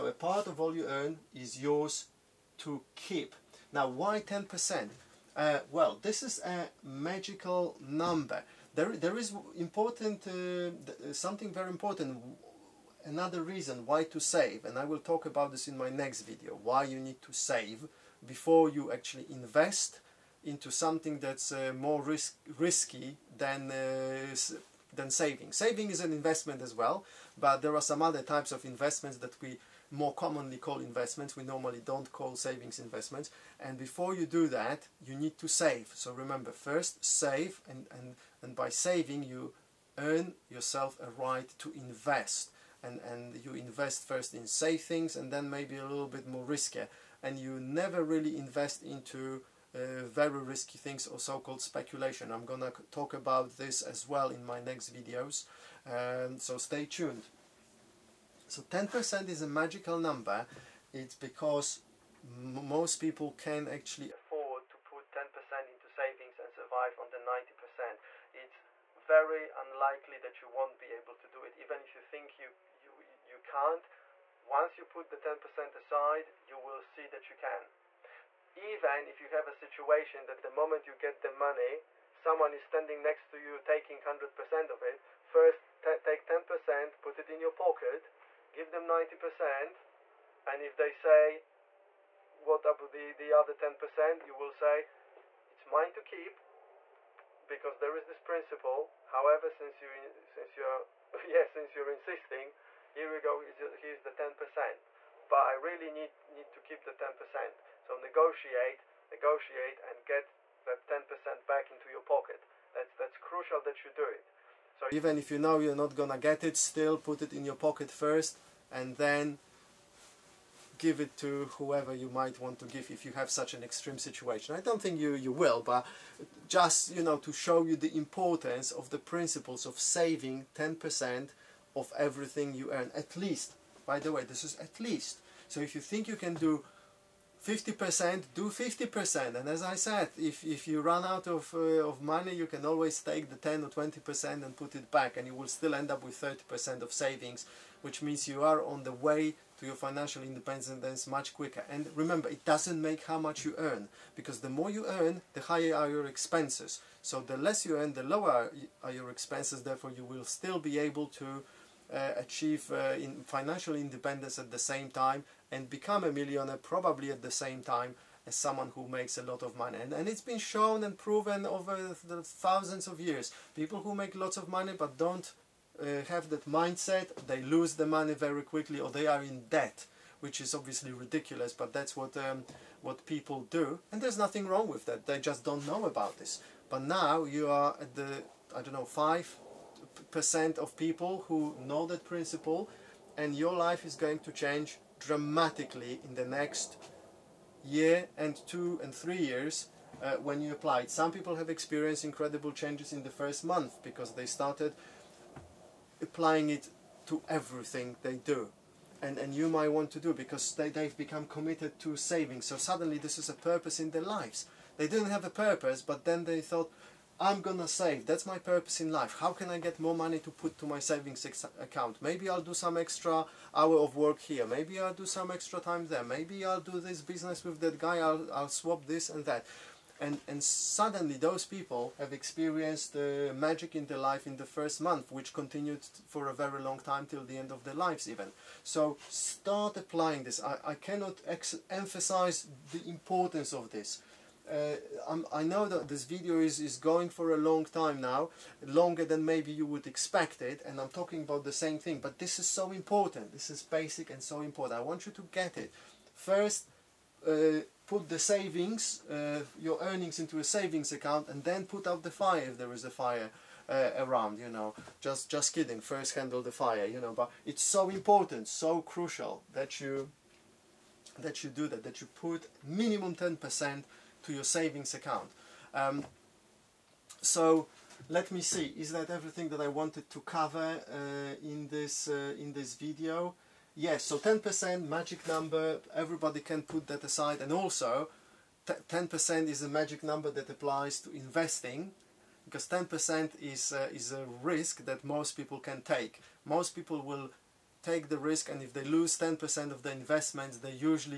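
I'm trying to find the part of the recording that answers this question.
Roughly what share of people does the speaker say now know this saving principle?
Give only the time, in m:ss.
3:08.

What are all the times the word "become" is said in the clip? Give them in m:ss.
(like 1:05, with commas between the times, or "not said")
2:45, 3:30.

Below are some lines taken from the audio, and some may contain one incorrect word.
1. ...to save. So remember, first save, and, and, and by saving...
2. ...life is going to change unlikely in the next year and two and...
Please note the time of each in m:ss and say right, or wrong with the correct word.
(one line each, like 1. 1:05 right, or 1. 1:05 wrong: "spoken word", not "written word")
1. 0:35 right
2. 3:13 wrong: "dramatically", not "unlikely".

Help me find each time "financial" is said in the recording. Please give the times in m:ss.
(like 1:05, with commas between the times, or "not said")
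2:29, 2:43.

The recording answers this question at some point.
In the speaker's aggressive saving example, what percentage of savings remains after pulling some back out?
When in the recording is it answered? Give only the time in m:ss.
2:26.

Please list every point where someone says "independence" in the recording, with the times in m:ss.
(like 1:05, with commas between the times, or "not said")
2:30, 2:43.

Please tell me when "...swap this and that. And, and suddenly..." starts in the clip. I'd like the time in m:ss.
3:48.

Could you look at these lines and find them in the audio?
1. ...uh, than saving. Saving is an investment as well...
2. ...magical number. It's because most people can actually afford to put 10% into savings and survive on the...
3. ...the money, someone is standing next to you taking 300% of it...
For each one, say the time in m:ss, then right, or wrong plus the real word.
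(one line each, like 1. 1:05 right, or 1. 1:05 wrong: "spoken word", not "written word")
1. 0:23 right
2. 0:59 right
3. 1:21 wrong: "100", not "300".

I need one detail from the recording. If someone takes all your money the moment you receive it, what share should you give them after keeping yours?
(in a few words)
90%.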